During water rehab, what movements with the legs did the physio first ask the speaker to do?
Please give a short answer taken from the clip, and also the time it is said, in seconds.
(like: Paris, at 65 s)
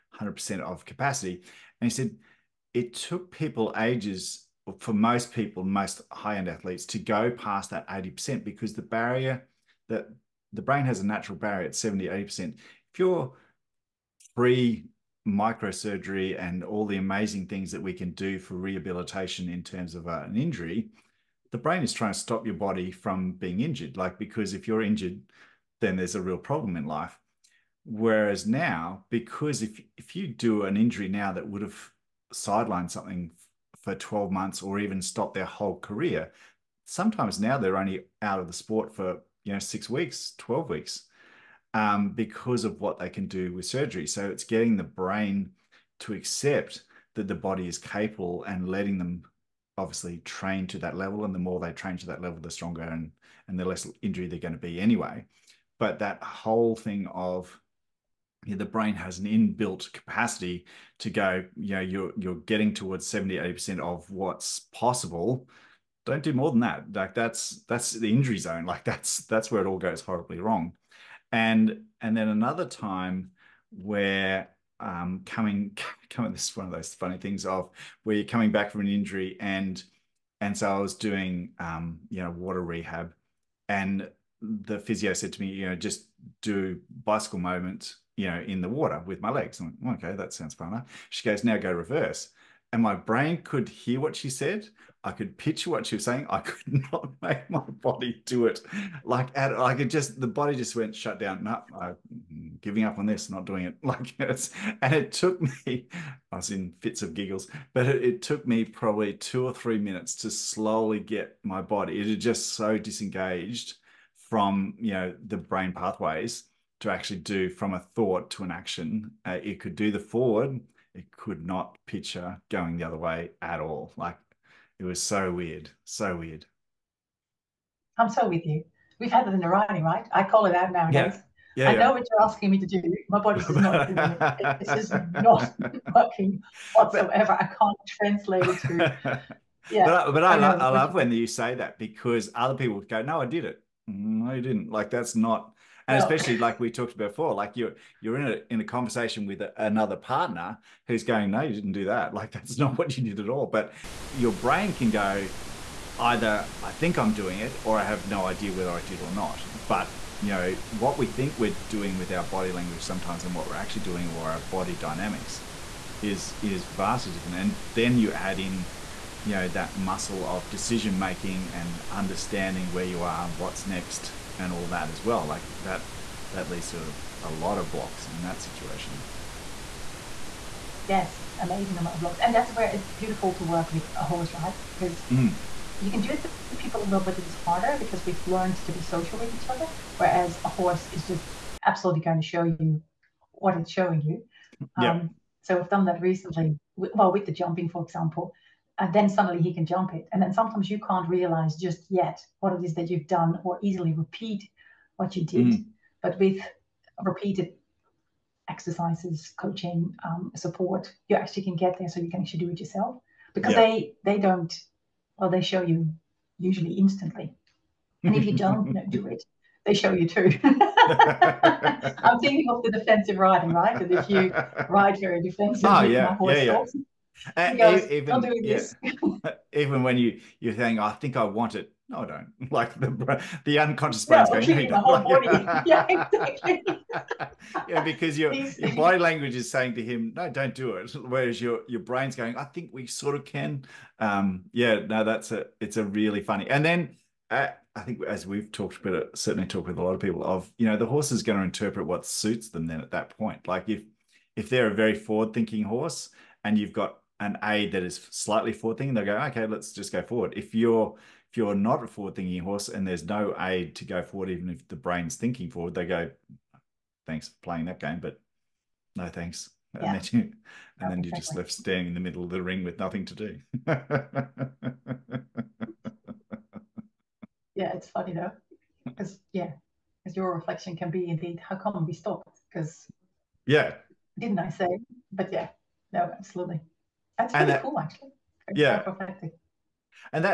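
Bicycle movements, at 87 s.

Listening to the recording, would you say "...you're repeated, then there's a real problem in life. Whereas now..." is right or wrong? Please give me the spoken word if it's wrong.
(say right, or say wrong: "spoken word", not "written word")
wrong: "injured", not "repeated".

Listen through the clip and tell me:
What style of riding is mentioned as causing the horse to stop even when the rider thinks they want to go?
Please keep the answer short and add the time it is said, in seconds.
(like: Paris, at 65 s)
Defensive riding, at 222 s.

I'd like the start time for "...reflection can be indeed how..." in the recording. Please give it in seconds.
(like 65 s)
280 s.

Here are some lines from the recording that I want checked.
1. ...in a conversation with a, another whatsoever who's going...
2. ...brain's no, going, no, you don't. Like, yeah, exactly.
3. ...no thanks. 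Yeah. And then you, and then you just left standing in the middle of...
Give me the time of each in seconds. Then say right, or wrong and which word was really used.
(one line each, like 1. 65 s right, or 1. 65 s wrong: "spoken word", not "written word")
1. 148 s wrong: "partner", not "whatsoever"
2. 234 s right
3. 268 s right.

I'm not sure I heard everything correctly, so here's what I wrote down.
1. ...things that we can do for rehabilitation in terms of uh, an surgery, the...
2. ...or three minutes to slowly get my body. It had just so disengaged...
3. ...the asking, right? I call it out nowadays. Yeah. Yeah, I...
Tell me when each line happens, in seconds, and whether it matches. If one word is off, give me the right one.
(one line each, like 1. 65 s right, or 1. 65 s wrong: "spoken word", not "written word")
1. 17 s wrong: "injury", not "surgery"
2. 109 s right
3. 129 s wrong: "writing", not "asking".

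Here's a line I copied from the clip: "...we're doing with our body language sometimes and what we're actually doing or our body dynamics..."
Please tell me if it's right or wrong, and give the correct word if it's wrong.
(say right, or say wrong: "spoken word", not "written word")
right.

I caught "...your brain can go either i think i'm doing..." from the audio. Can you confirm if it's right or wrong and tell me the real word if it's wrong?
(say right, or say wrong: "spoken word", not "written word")
right.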